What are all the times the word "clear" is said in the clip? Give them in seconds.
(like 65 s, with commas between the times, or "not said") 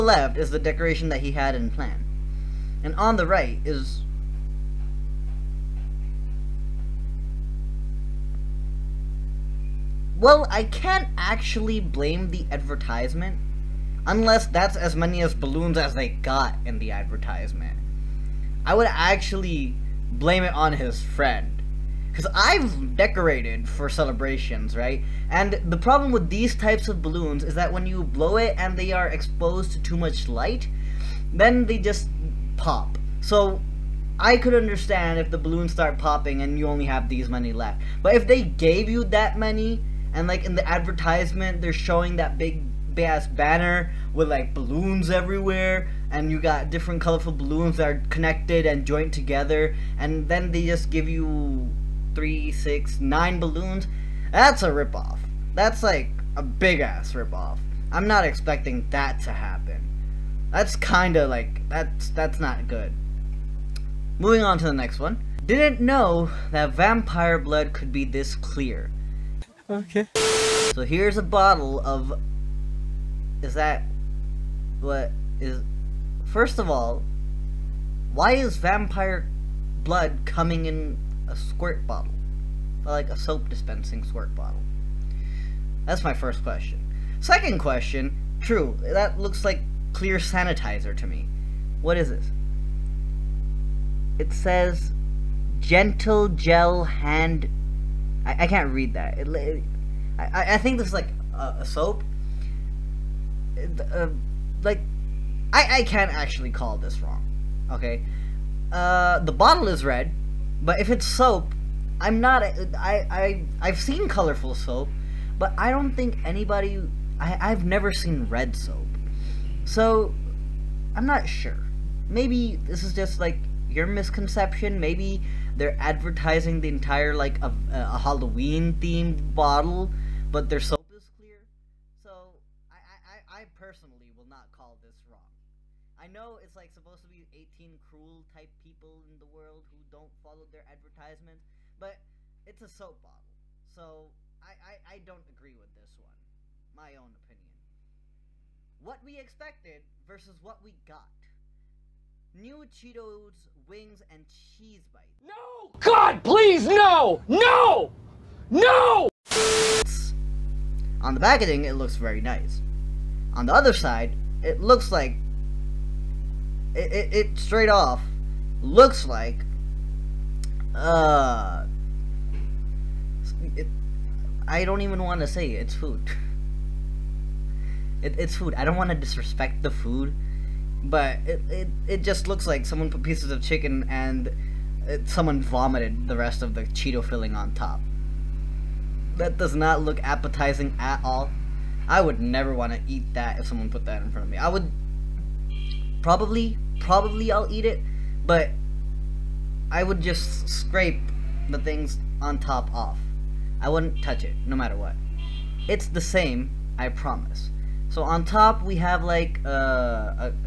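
68 s, 89 s, 131 s.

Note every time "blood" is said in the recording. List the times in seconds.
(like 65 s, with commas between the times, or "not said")
67 s, 79 s.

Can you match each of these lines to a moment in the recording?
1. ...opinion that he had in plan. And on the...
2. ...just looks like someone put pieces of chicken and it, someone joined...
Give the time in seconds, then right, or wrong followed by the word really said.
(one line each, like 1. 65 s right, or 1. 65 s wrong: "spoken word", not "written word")
1. 0 s wrong: "decoration", not "opinion"
2. 182 s wrong: "vomited", not "joined".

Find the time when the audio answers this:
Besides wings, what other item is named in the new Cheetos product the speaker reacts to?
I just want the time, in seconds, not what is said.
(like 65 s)
154 s.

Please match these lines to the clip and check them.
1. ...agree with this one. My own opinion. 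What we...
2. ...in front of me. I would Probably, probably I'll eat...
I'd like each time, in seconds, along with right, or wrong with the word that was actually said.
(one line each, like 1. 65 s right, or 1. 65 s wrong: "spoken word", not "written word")
1. 145 s right
2. 194 s right.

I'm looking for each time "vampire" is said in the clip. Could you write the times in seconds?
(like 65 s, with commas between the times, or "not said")
66 s, 78 s.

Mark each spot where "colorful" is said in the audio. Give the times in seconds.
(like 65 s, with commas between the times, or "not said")
47 s, 114 s.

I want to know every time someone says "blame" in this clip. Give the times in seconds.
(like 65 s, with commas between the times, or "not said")
11 s, 20 s.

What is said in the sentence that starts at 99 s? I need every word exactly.
It, it, I, I think this is like a, a soap.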